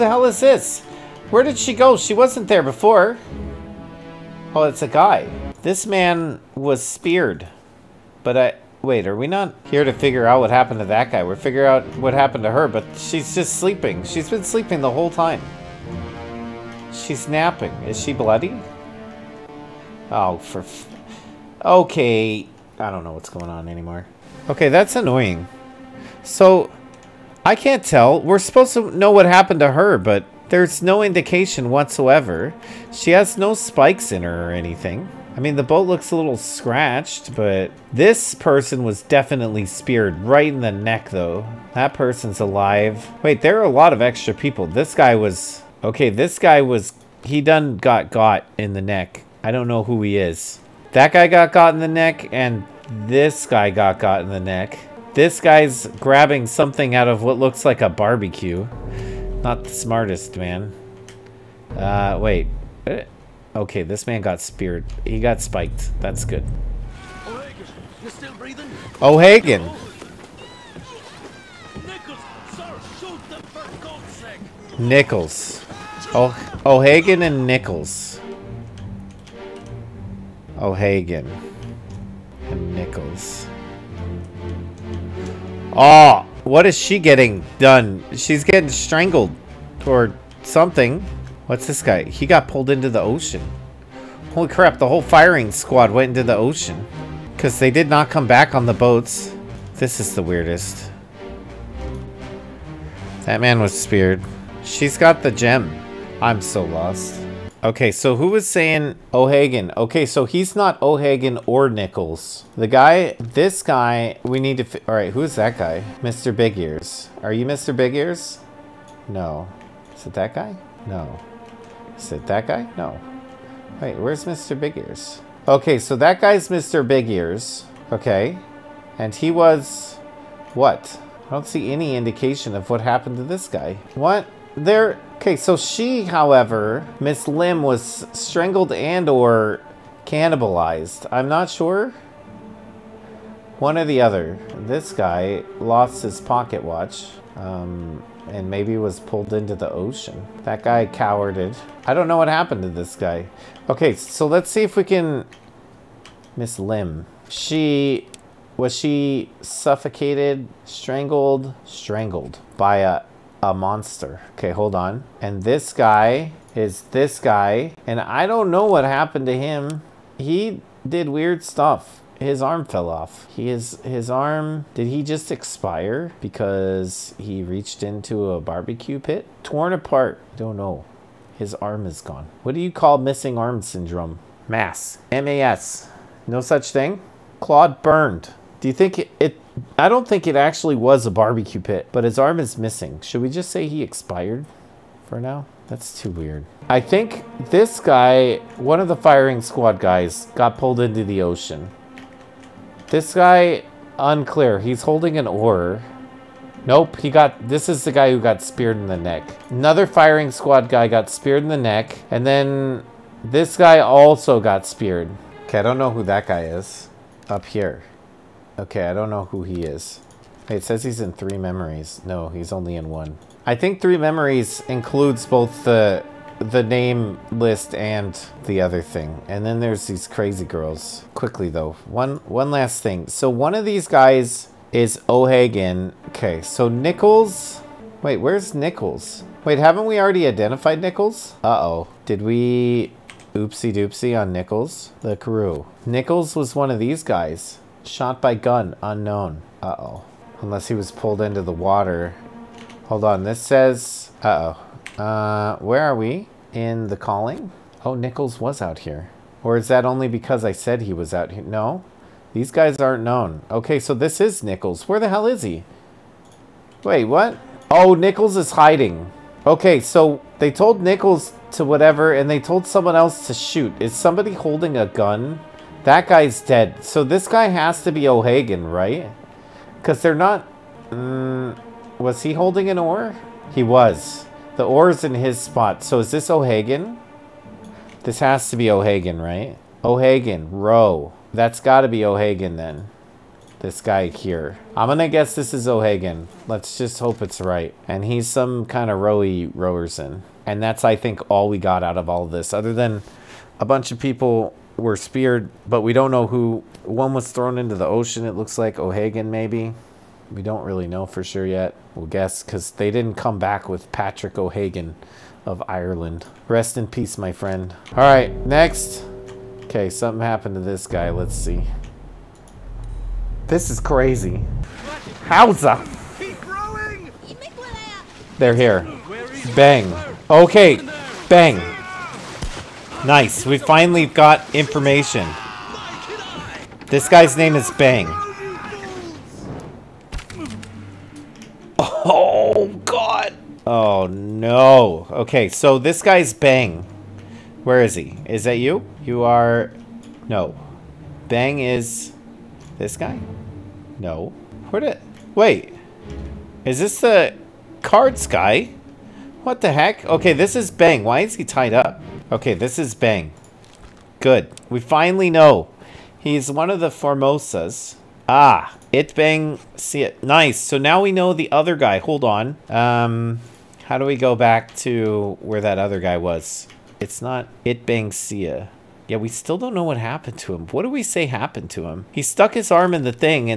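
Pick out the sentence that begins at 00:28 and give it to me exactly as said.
We're supposed to know what happened to her, but there's no indication whatsoever.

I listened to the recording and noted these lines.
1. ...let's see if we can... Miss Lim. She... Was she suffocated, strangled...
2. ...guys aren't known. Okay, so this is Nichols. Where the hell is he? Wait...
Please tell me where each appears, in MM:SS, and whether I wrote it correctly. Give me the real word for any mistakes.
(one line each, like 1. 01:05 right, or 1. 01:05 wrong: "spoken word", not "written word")
1. 02:34 right
2. 04:22 right.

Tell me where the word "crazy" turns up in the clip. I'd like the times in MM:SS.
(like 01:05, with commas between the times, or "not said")
03:50, 05:23.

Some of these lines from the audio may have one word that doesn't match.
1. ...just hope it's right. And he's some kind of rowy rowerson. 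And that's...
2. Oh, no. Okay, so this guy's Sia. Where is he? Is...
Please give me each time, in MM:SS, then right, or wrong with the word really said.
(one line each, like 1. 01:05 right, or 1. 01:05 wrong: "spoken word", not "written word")
1. 04:56 right
2. 05:43 wrong: "Bang", not "Sia".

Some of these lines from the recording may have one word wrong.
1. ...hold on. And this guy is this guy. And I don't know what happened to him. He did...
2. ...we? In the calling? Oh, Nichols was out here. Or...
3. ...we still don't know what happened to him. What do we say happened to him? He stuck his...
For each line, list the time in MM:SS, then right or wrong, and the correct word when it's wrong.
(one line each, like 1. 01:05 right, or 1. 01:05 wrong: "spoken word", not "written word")
1. 02:44 right
2. 04:15 right
3. 06:19 right.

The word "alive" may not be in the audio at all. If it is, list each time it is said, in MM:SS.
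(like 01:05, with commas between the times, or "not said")
00:42.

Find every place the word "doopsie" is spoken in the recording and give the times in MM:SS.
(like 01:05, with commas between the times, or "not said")
04:03.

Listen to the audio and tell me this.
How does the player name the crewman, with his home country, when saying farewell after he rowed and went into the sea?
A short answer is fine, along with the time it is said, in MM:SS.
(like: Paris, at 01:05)
Patrick O'Hagan of Ireland, at 05:13.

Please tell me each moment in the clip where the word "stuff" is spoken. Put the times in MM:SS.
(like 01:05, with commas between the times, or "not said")
02:51.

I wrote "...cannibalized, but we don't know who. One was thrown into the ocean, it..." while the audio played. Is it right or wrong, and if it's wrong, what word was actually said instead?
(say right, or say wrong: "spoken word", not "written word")
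wrong: "speared", not "cannibalized".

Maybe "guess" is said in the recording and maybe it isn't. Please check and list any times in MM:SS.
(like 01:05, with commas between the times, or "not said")
04:55, 05:12.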